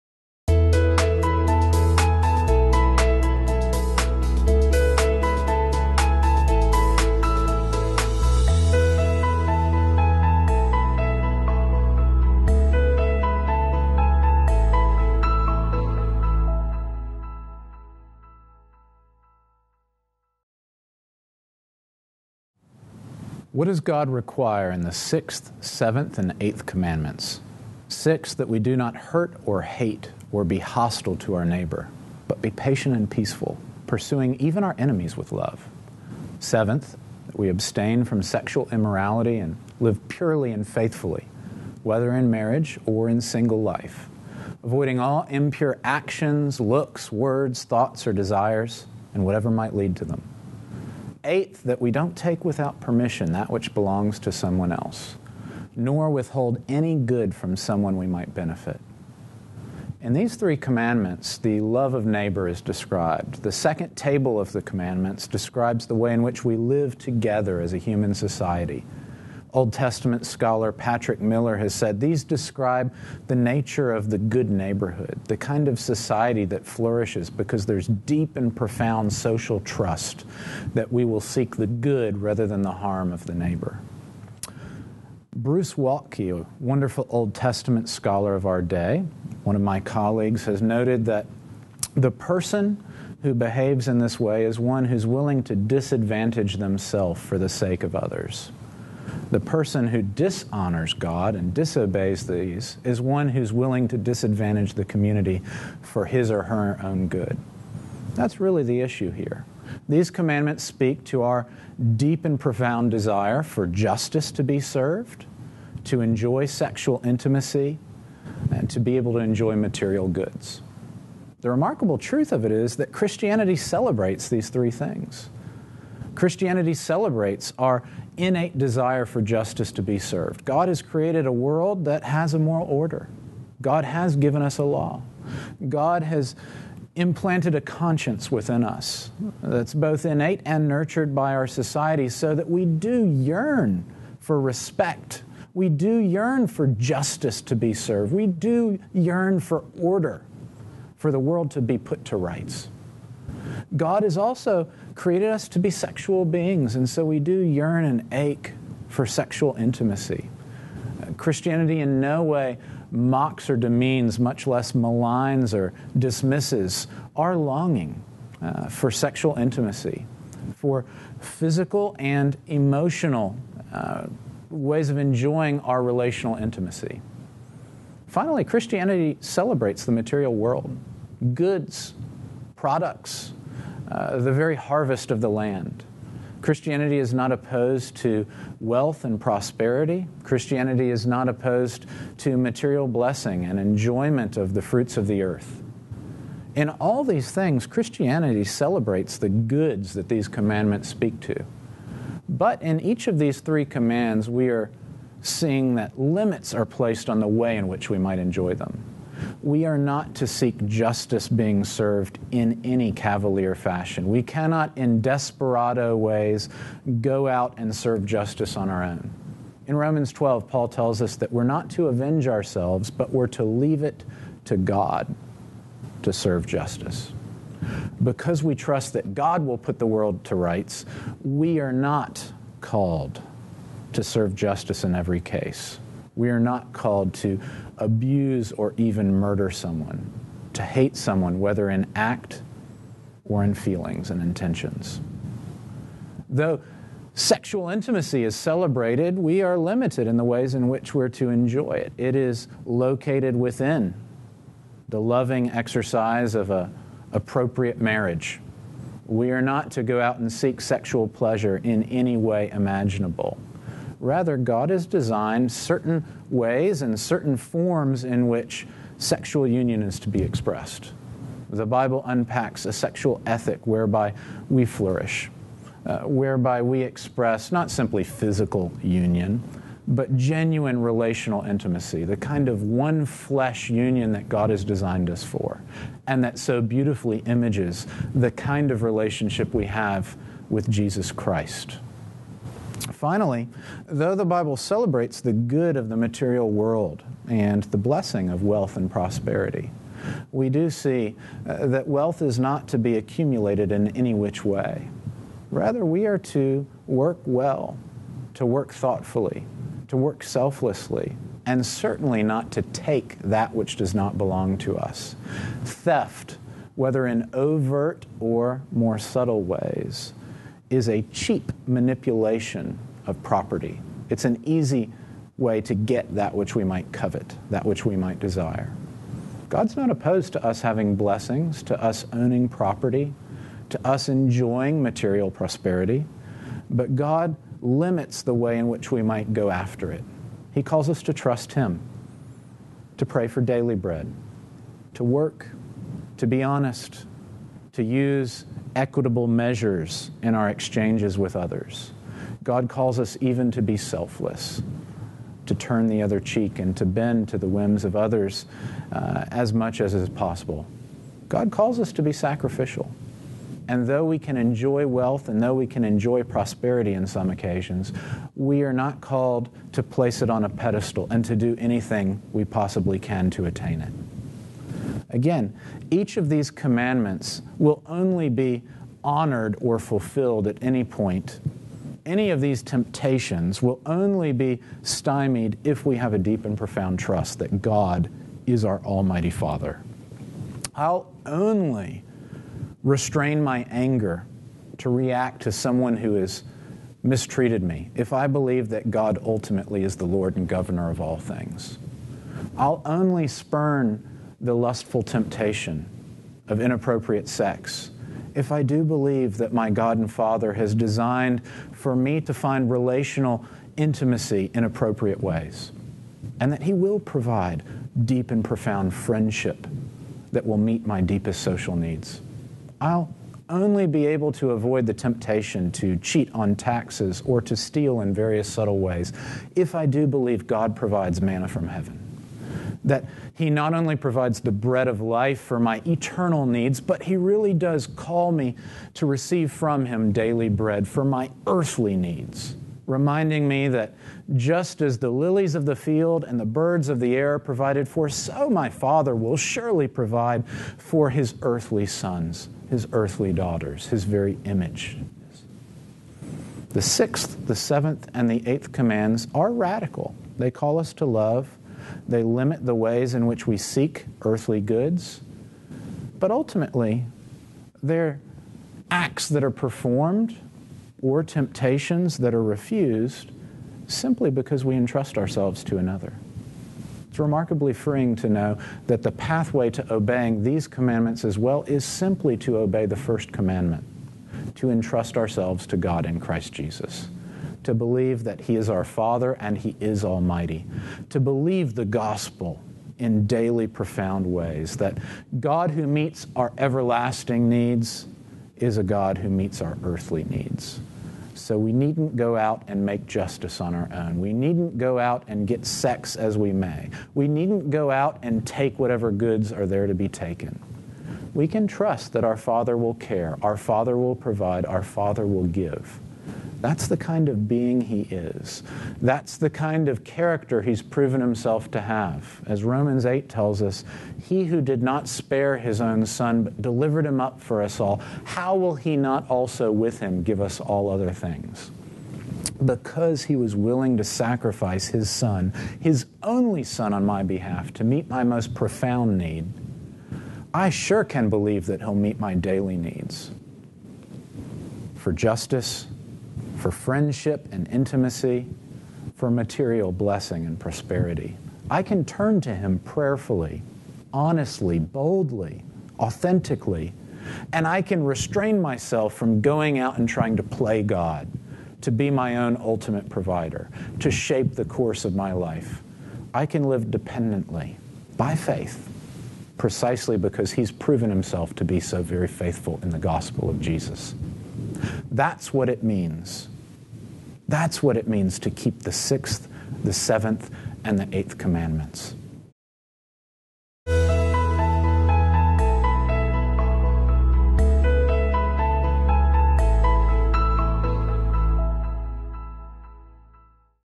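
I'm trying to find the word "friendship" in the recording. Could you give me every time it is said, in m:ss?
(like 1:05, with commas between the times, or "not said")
6:58, 9:06.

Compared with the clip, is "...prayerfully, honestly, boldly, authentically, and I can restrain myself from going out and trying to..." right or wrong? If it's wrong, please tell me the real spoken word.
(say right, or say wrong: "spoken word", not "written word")
right.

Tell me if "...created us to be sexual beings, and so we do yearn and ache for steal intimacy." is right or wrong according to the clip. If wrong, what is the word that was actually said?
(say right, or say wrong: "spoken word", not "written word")
wrong: "sexual", not "steal".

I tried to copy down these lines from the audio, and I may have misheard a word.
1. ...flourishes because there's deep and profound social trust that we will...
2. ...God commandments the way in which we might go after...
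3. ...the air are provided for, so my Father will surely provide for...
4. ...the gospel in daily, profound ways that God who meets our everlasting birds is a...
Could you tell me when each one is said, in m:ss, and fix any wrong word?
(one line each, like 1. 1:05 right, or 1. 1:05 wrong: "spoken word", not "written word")
1. 1:16 right
2. 5:36 wrong: "limits", not "commandments"
3. 7:26 right
4. 8:11 wrong: "needs", not "birds".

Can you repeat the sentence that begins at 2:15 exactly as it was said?
God has implanted a conscience within us that's both innate and nurtured by our society so that we do yearn for respect.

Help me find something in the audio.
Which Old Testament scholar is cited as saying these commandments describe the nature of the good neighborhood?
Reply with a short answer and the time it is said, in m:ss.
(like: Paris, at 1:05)
Patrick Miller, at 1:10.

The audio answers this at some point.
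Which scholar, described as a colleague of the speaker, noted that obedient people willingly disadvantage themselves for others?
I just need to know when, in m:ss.
1:25.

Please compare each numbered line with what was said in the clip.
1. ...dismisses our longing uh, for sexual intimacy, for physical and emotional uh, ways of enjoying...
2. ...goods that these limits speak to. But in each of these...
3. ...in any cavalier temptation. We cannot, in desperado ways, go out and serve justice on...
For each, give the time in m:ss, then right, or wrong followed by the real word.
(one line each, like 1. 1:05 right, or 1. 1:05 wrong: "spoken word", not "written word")
1. 2:45 right
2. 3:19 wrong: "commandments", not "limits"
3. 3:32 wrong: "fashion", not "temptation".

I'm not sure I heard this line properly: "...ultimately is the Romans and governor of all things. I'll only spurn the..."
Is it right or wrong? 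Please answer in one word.
wrong.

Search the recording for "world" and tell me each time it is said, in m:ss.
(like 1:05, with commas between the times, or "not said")
2:11, 2:31, 3:00, 3:49, 4:56.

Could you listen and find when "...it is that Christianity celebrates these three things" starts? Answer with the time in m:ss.
2:02.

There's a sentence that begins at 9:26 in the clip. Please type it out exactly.
I can live dependently by faith precisely because he's proven himself to be so very faithful in the gospel of Jesus.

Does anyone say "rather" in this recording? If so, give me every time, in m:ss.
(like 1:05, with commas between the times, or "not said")
1:22, 4:24, 5:05.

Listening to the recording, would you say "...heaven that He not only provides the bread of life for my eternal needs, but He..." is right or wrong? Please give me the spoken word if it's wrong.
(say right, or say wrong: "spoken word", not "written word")
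right.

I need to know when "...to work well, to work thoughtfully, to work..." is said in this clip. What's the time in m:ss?
5:06.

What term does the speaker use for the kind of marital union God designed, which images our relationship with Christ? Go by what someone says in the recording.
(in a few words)
one flesh union.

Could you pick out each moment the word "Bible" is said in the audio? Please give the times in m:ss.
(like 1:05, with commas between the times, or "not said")
4:31, 4:54.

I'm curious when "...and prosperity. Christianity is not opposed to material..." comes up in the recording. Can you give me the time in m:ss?
3:09.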